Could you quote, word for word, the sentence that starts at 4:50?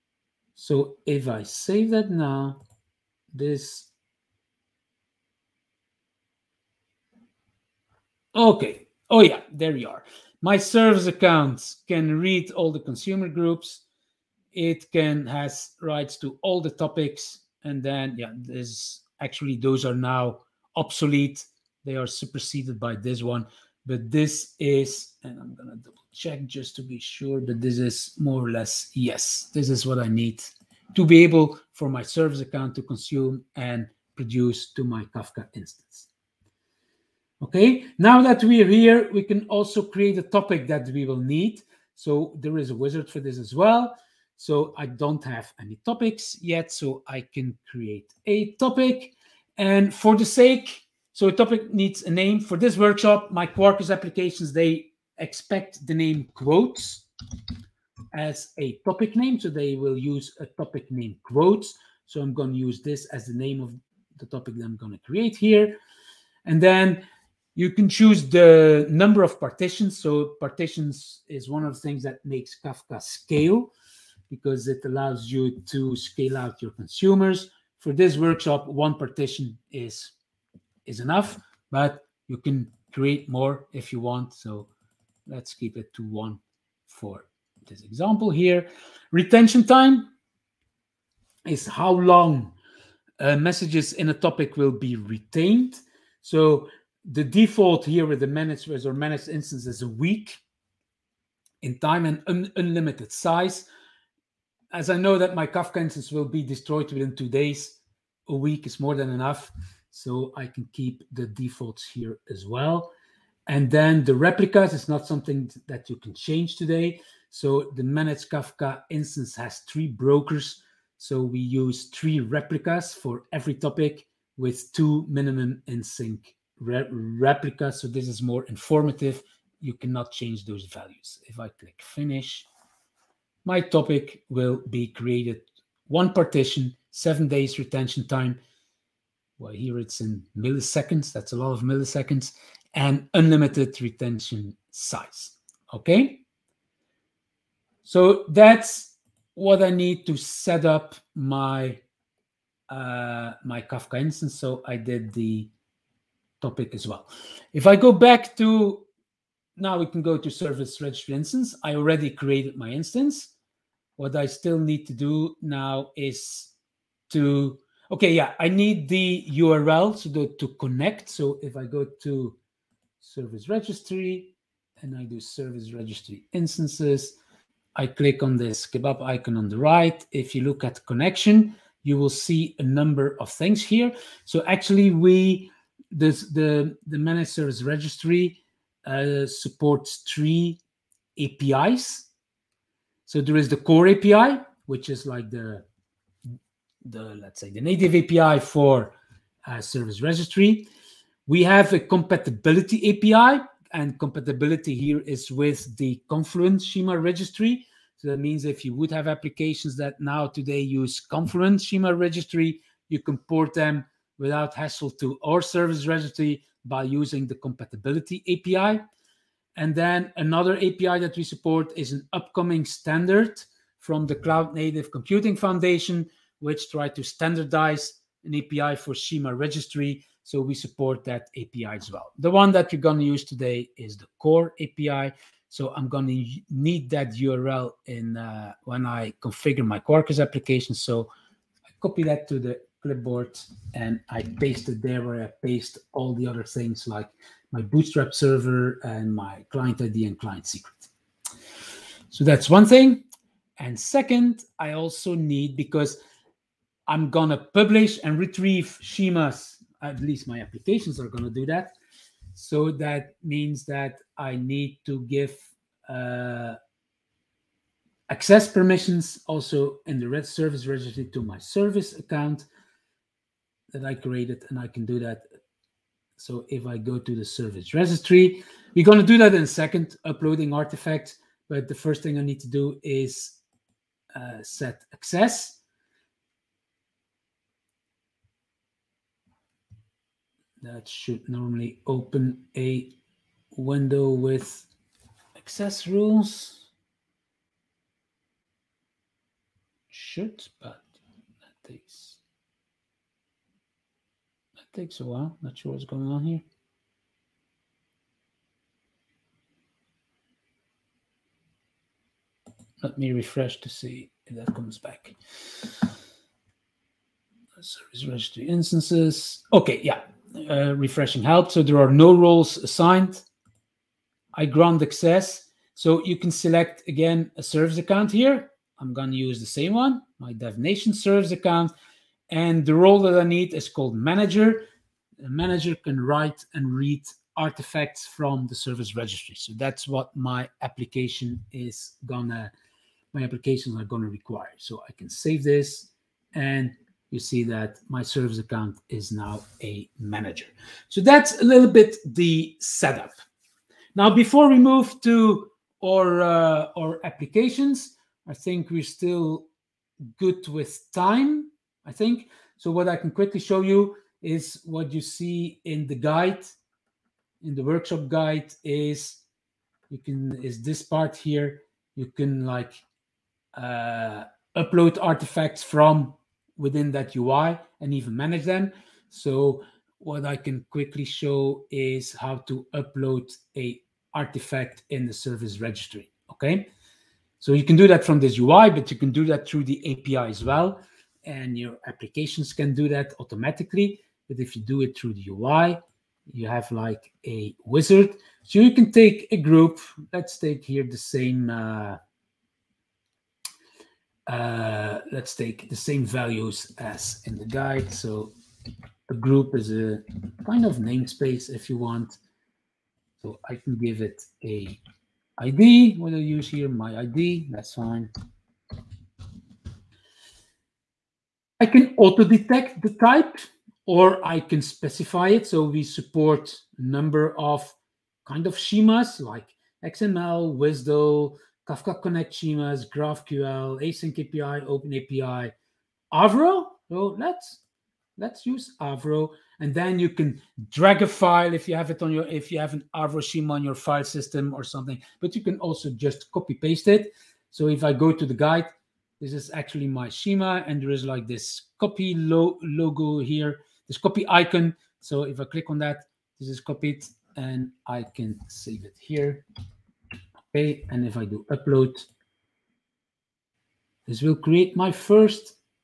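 that should normally open a window with access rules.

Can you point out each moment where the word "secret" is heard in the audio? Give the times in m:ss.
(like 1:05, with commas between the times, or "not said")
4:10.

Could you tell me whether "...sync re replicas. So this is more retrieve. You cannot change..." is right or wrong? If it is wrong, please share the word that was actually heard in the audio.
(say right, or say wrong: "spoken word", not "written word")
wrong: "informative", not "retrieve".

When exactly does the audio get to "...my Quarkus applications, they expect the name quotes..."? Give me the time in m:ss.
0:53.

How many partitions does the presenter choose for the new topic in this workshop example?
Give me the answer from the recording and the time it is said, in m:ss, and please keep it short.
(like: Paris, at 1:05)
1, at 1:24.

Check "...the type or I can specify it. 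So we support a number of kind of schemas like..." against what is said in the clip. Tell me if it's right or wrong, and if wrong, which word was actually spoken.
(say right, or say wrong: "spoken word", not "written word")
right.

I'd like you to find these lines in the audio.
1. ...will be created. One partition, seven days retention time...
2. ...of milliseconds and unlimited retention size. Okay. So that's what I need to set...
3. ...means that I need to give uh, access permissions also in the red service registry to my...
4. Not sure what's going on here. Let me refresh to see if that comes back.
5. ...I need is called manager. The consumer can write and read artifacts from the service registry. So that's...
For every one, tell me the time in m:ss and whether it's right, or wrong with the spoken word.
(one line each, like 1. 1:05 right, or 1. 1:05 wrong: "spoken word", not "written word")
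1. 2:14 right
2. 2:21 right
3. 4:23 right
4. 5:05 right
5. 5:33 wrong: "manager", not "consumer".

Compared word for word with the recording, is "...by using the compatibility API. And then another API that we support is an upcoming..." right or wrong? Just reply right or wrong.
right.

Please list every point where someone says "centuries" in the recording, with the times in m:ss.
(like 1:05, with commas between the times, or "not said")
not said.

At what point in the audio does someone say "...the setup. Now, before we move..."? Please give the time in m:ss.
5:52.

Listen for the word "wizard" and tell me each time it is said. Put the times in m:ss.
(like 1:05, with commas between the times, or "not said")
0:42, 6:37.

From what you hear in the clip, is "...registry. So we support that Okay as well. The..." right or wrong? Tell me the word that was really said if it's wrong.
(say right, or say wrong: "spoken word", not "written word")
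wrong: "API", not "Okay".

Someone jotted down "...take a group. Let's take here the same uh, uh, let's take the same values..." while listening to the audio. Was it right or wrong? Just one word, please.
right.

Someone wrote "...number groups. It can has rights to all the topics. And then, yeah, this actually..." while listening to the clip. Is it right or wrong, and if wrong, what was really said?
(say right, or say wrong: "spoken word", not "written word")
wrong: "consumer", not "number".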